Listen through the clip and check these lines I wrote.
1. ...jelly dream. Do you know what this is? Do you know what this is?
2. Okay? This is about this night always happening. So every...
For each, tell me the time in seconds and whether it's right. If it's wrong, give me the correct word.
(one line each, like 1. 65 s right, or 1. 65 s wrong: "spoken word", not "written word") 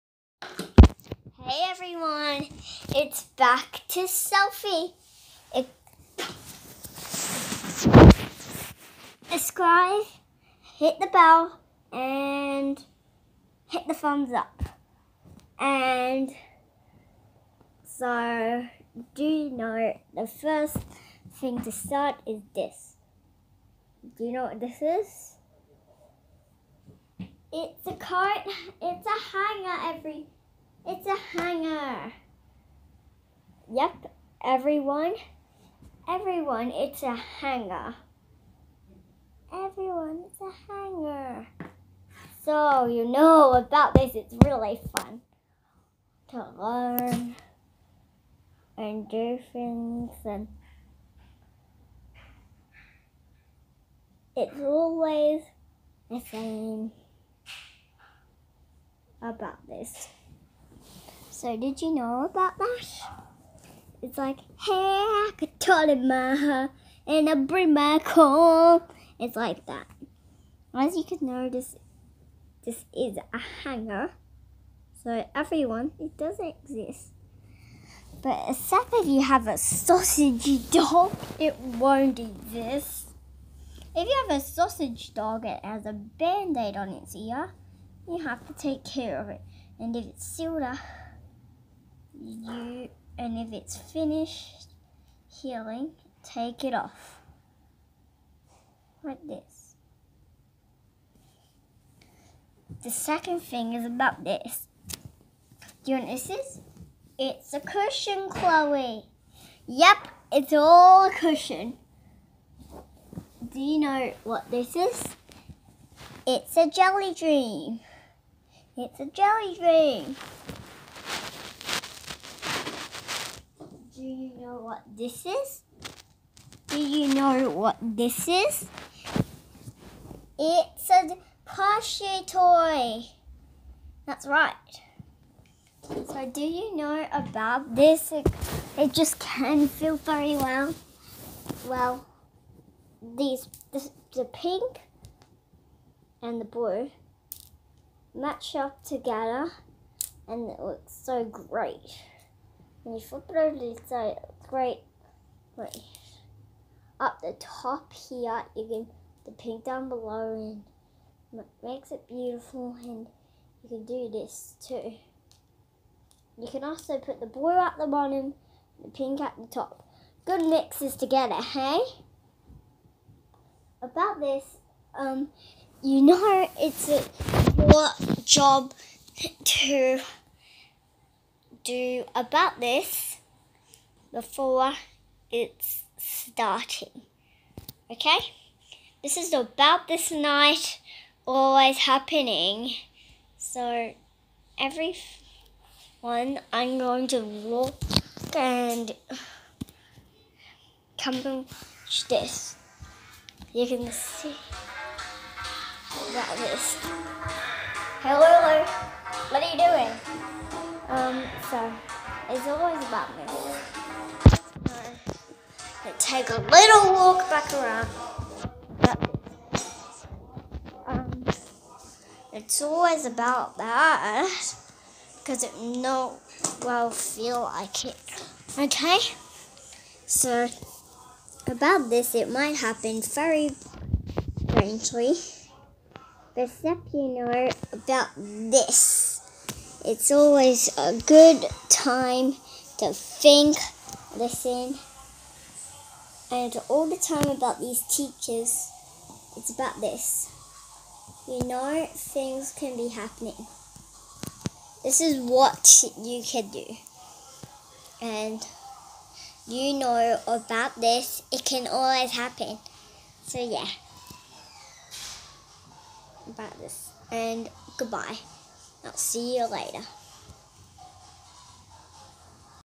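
1. 119 s right
2. 187 s right.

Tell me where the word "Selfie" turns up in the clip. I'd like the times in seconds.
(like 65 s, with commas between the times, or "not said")
4 s.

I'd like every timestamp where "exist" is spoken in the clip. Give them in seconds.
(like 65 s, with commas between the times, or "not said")
76 s, 82 s.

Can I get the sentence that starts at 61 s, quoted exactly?
So did you know about that?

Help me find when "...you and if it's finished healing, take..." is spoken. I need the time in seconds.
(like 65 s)
92 s.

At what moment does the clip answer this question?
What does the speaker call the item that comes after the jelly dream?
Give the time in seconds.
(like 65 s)
131 s.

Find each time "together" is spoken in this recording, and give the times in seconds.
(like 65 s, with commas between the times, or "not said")
148 s, 170 s.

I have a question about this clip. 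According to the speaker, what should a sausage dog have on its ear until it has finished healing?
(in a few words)
Band-aid.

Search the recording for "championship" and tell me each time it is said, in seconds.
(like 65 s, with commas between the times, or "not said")
not said.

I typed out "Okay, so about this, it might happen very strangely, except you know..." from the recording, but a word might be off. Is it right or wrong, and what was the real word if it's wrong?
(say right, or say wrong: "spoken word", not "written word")
right.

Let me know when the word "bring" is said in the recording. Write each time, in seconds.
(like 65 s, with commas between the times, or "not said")
67 s.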